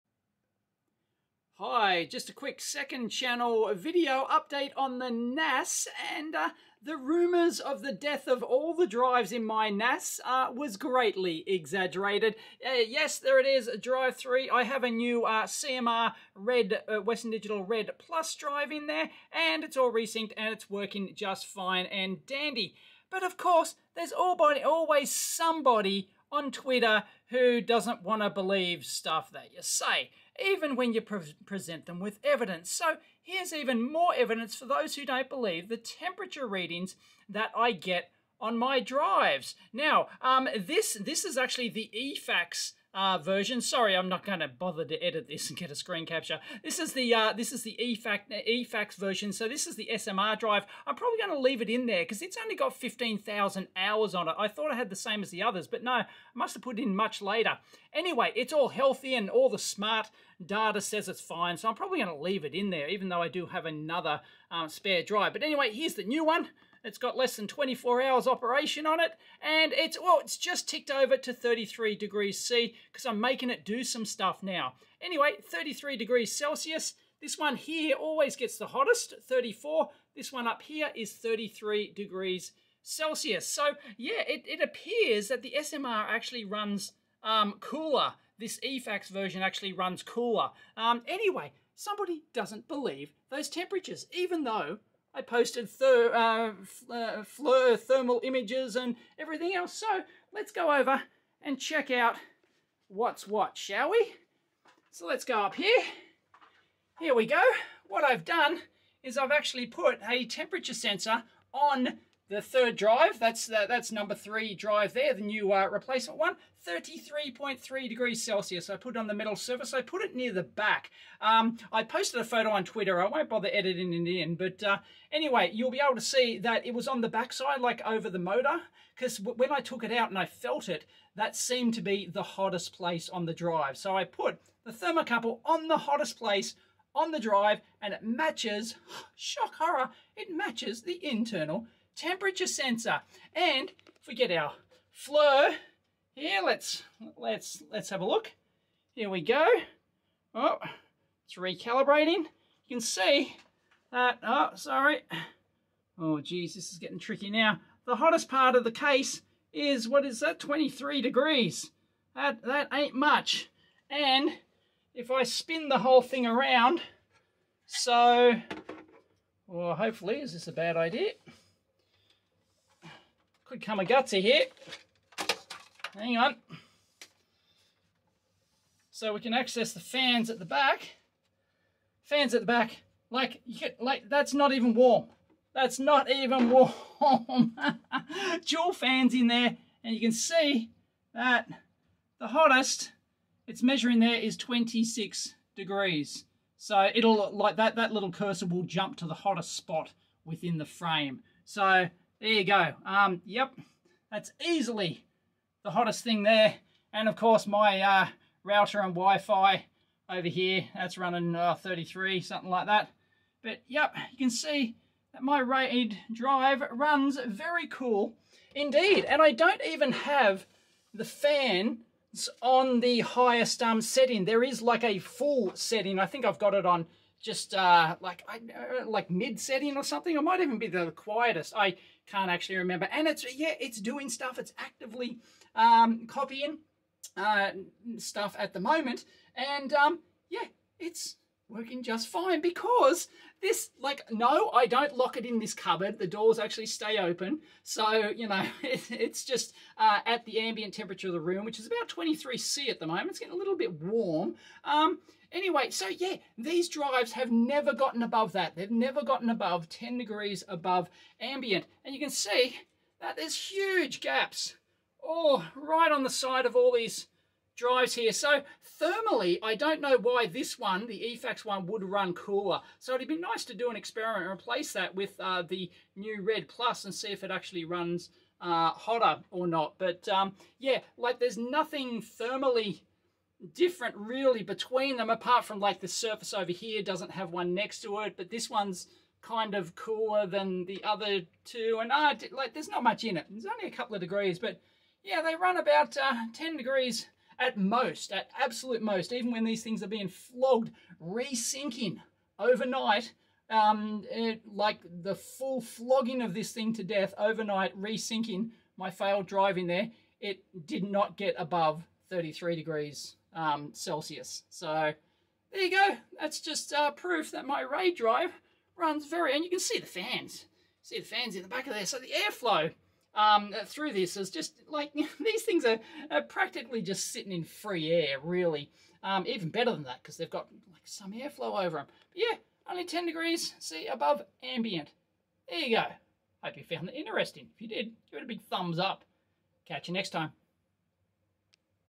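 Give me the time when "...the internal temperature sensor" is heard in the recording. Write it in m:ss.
2:20.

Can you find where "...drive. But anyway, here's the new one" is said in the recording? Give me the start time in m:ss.
1:05.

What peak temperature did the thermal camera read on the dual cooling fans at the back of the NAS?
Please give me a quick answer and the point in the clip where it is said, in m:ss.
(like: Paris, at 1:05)
26 degrees, at 3:14.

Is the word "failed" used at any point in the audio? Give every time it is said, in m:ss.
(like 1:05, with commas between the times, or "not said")
5:08.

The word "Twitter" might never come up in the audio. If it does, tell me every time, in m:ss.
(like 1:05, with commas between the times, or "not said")
0:26, 2:02.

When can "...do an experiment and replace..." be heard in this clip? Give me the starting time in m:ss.
4:33.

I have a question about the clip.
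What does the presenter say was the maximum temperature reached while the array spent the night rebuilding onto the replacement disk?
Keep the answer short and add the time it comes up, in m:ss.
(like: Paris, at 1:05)
33 degrees Celsius, at 5:12.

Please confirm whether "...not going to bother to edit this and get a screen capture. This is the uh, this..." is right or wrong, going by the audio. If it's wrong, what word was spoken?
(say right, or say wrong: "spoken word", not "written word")
right.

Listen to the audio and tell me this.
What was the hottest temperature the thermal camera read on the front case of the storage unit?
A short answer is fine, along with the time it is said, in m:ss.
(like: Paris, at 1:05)
23 degrees, at 2:40.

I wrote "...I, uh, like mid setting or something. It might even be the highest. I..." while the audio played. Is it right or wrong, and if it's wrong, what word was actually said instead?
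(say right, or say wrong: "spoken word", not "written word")
wrong: "quietest", not "highest".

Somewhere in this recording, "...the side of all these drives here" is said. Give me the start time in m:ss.
4:26.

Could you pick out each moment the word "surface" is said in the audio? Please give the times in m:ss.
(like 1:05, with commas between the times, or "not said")
1:59, 4:45.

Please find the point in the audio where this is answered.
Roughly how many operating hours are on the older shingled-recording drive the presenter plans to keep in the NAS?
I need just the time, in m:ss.
0:52.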